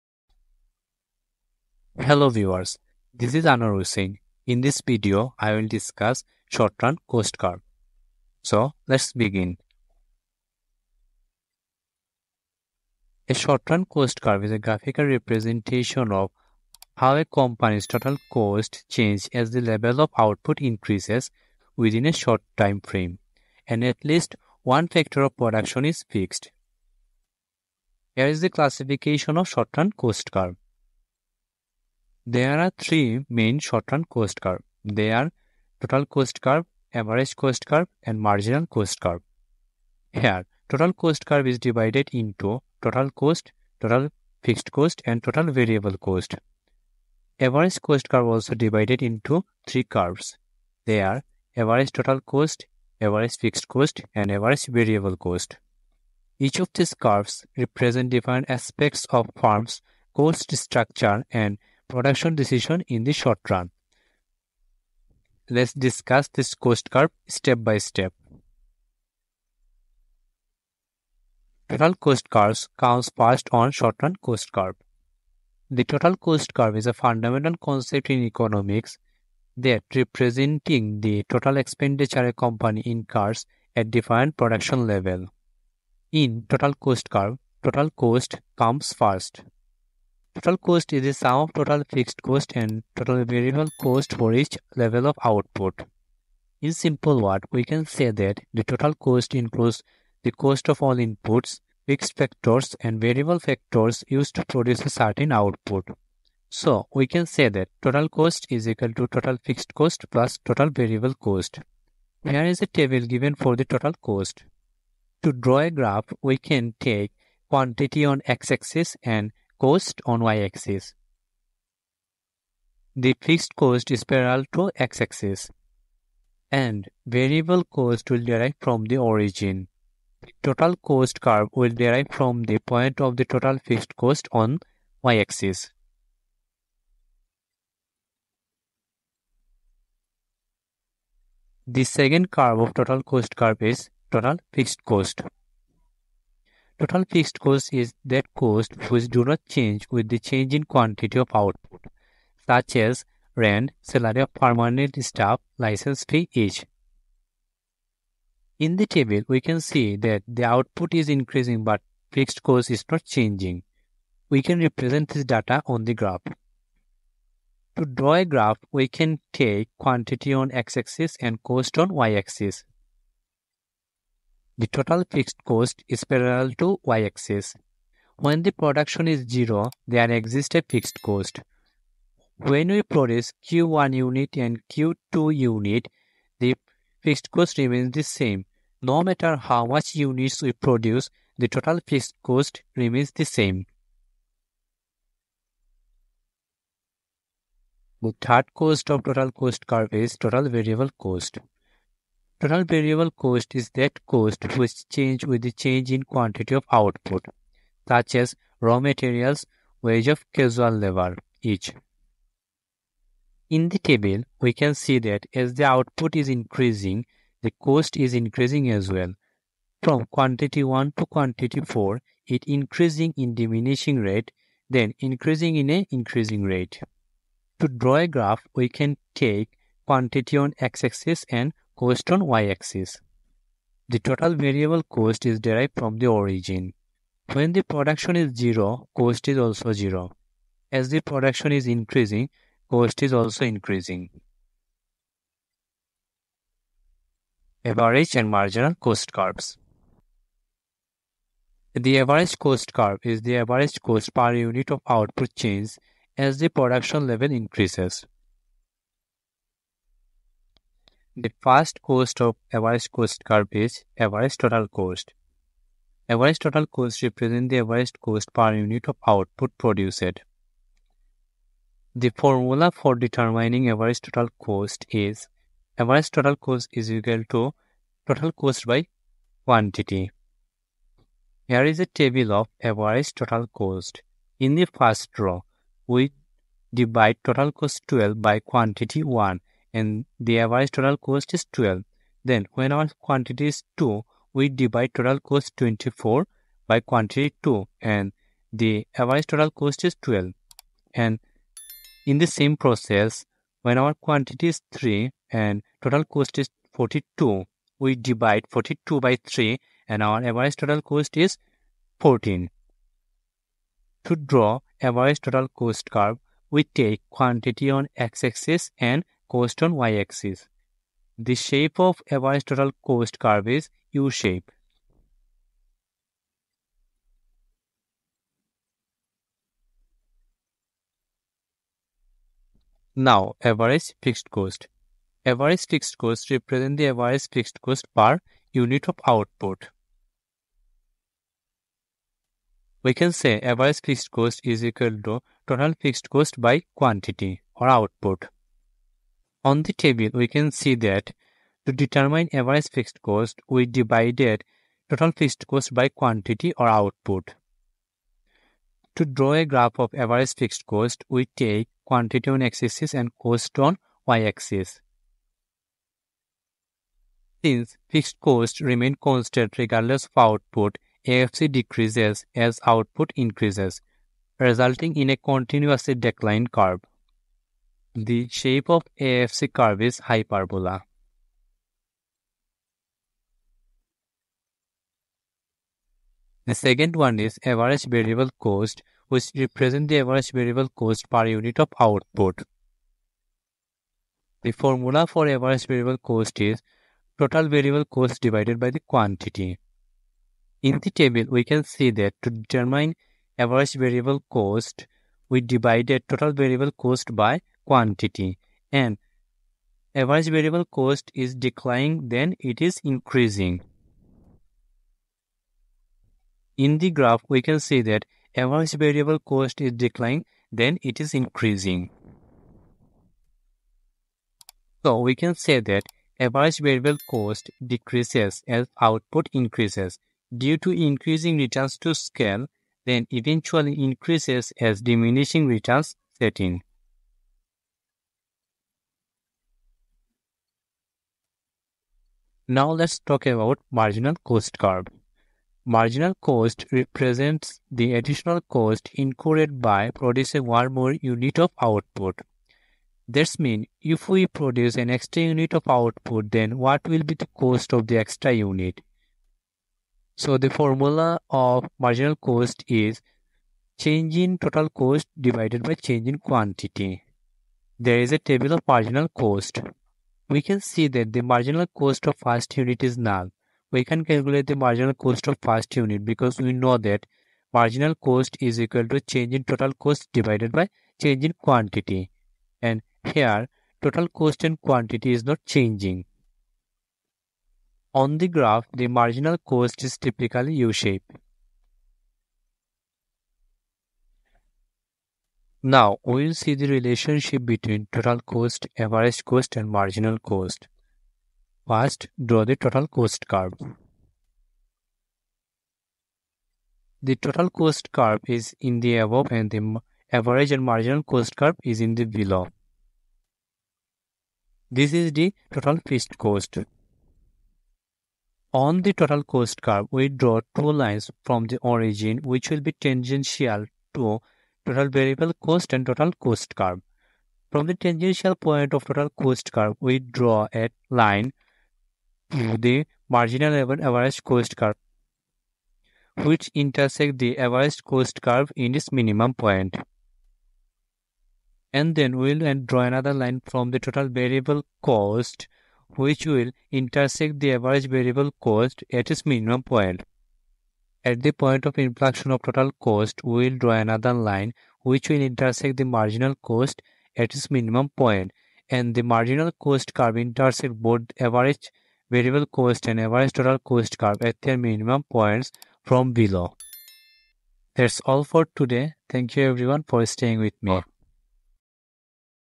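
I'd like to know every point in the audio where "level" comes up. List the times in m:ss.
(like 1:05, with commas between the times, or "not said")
0:19, 1:24, 1:34, 4:17, 8:53.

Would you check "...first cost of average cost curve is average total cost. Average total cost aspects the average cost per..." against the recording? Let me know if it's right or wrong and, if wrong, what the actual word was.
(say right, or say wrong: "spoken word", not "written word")
wrong: "represents", not "aspects".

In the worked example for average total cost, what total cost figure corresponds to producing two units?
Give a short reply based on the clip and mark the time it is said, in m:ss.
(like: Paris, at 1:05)
24, at 4:55.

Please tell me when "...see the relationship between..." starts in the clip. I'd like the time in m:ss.
8:16.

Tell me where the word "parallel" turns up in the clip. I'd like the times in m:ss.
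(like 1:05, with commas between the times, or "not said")
2:04, 2:56.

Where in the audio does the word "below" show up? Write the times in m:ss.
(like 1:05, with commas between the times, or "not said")
8:32, 9:26.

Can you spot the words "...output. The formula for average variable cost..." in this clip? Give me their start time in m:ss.
6:31.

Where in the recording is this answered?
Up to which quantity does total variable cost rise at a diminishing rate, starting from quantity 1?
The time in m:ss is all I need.
3:41.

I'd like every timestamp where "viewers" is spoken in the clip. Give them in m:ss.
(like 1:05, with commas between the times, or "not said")
0:02.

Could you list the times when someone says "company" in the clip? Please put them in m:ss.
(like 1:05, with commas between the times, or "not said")
0:17, 1:22.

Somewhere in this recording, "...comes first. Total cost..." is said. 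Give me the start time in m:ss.
1:28.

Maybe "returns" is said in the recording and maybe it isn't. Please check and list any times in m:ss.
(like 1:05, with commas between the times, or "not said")
7:11, 7:15.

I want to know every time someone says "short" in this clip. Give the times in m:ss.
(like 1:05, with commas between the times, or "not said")
0:06, 0:13, 0:22, 0:29, 0:33, 1:03, 1:13.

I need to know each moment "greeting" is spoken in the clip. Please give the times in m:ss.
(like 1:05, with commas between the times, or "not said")
not said.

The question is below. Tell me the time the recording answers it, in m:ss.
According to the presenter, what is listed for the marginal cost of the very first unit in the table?
7:52.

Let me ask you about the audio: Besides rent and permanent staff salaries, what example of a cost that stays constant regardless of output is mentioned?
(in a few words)
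License fee.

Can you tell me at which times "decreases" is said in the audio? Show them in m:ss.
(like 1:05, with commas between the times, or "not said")
6:11, 7:07.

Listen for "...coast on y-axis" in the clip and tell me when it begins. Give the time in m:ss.
5:19.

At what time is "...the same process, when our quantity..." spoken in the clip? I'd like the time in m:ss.
5:02.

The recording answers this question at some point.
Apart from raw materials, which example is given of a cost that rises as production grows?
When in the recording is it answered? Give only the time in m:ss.
3:29.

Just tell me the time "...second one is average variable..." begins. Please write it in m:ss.
6:26.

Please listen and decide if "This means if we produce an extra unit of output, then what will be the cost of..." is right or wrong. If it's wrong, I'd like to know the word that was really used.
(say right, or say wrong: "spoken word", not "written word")
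right.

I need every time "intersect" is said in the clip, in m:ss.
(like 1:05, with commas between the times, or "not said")
8:56, 9:06, 9:15, 9:20.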